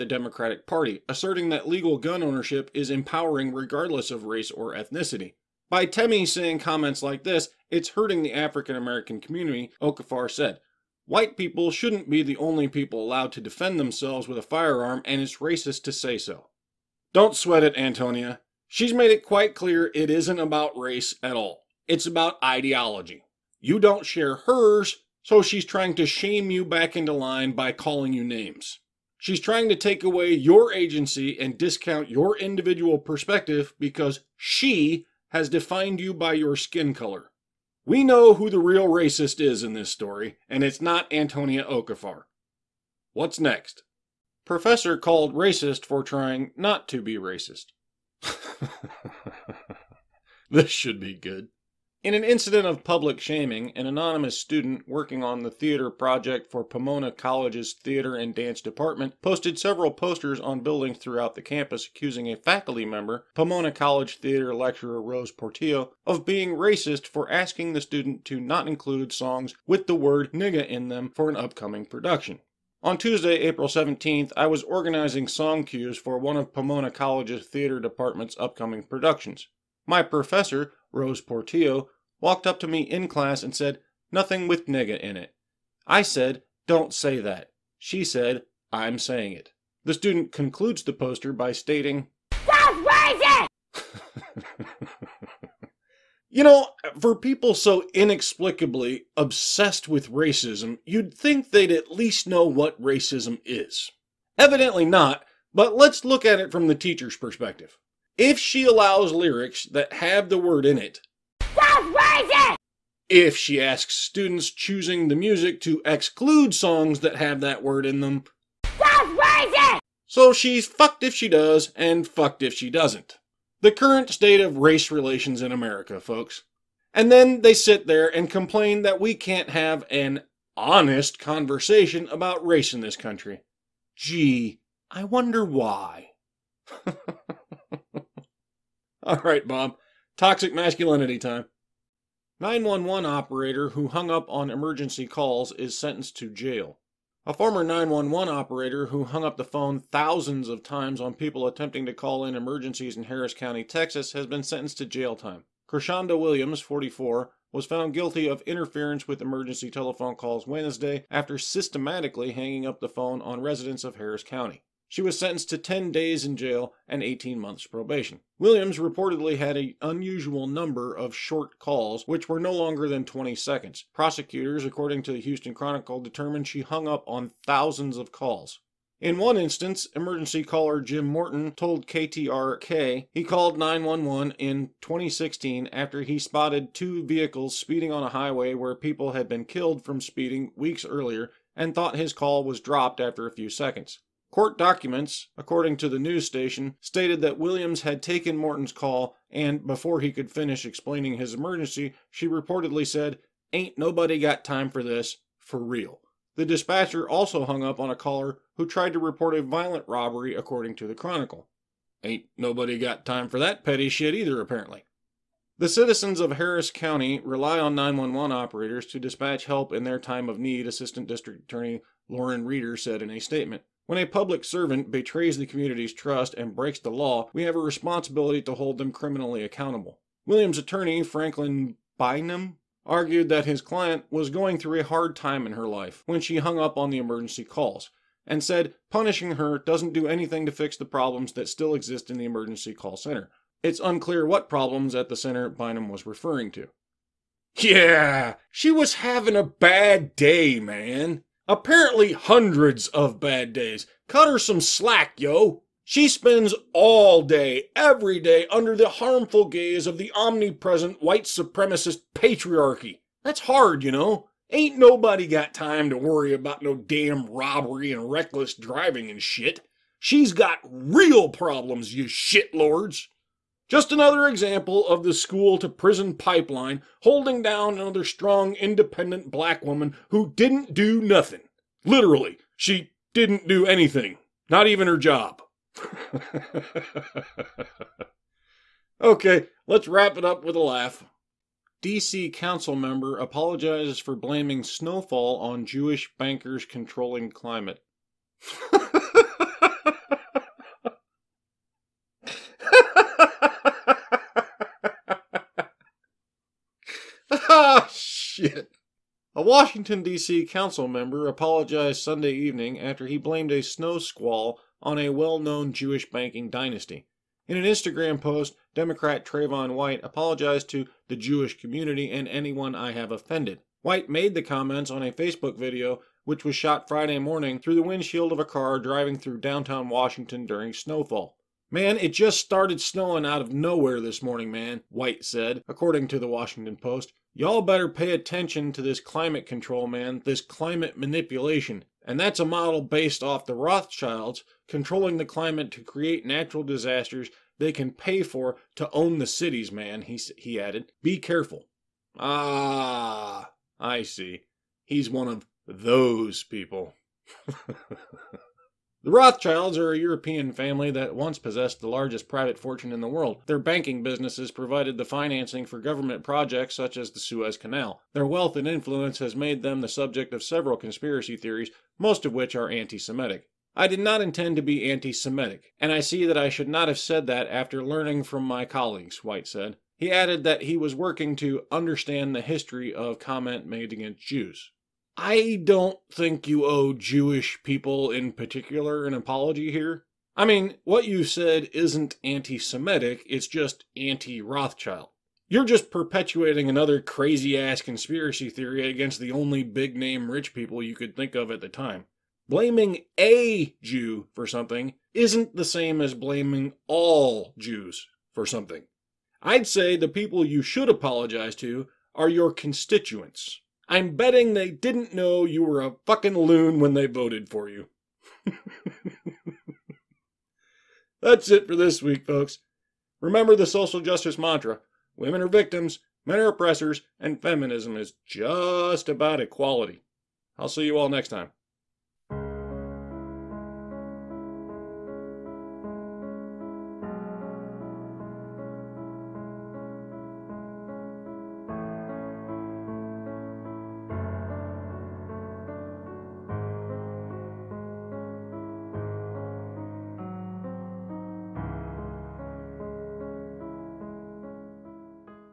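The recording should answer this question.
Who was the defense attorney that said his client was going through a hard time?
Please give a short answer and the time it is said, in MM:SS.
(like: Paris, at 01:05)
Franklin Bynum, at 03:51.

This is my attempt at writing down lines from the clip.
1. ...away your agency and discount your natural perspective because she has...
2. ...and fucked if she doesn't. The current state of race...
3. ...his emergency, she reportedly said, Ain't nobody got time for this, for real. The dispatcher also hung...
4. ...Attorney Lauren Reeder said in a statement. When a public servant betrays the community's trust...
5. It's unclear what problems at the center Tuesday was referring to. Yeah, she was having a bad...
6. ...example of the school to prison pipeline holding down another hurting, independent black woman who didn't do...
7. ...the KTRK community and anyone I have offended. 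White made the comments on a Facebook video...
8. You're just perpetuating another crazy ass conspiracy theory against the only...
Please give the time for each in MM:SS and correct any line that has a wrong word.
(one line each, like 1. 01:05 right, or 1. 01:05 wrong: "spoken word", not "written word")
1. 00:30 wrong: "individual", not "natural"
2. 02:01 right
3. 03:21 right
4. 03:41 right
5. 04:03 wrong: "Bynum", not "Tuesday"
6. 04:34 wrong: "strong", not "hurting"
7. 05:21 wrong: "Jewish", not "KTRK"
8. 06:35 right.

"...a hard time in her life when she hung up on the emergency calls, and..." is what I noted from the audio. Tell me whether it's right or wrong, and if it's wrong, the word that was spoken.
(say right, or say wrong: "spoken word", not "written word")
right.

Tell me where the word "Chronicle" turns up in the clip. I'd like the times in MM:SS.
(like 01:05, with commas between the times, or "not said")
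02:55, 03:30.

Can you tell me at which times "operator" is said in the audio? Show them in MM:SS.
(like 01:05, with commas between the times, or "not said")
02:23, 02:28, 03:38.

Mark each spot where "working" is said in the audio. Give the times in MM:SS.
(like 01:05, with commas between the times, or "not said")
00:54, 06:20.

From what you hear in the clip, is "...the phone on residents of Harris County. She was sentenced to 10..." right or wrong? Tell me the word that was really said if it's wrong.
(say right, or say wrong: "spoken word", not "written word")
right.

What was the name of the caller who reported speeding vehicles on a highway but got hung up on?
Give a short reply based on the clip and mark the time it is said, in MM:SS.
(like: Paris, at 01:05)
Jim Morton, at 03:00.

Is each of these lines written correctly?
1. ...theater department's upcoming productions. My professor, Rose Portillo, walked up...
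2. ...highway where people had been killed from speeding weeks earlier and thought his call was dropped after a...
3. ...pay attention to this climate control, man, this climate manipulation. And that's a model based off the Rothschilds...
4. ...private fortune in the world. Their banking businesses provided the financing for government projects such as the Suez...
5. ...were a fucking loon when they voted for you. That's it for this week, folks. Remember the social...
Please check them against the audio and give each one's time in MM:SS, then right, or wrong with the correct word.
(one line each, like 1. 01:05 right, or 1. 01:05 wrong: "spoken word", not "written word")
1. 01:17 right
2. 03:08 right
3. 05:37 right
4. 06:02 right
5. 06:55 right.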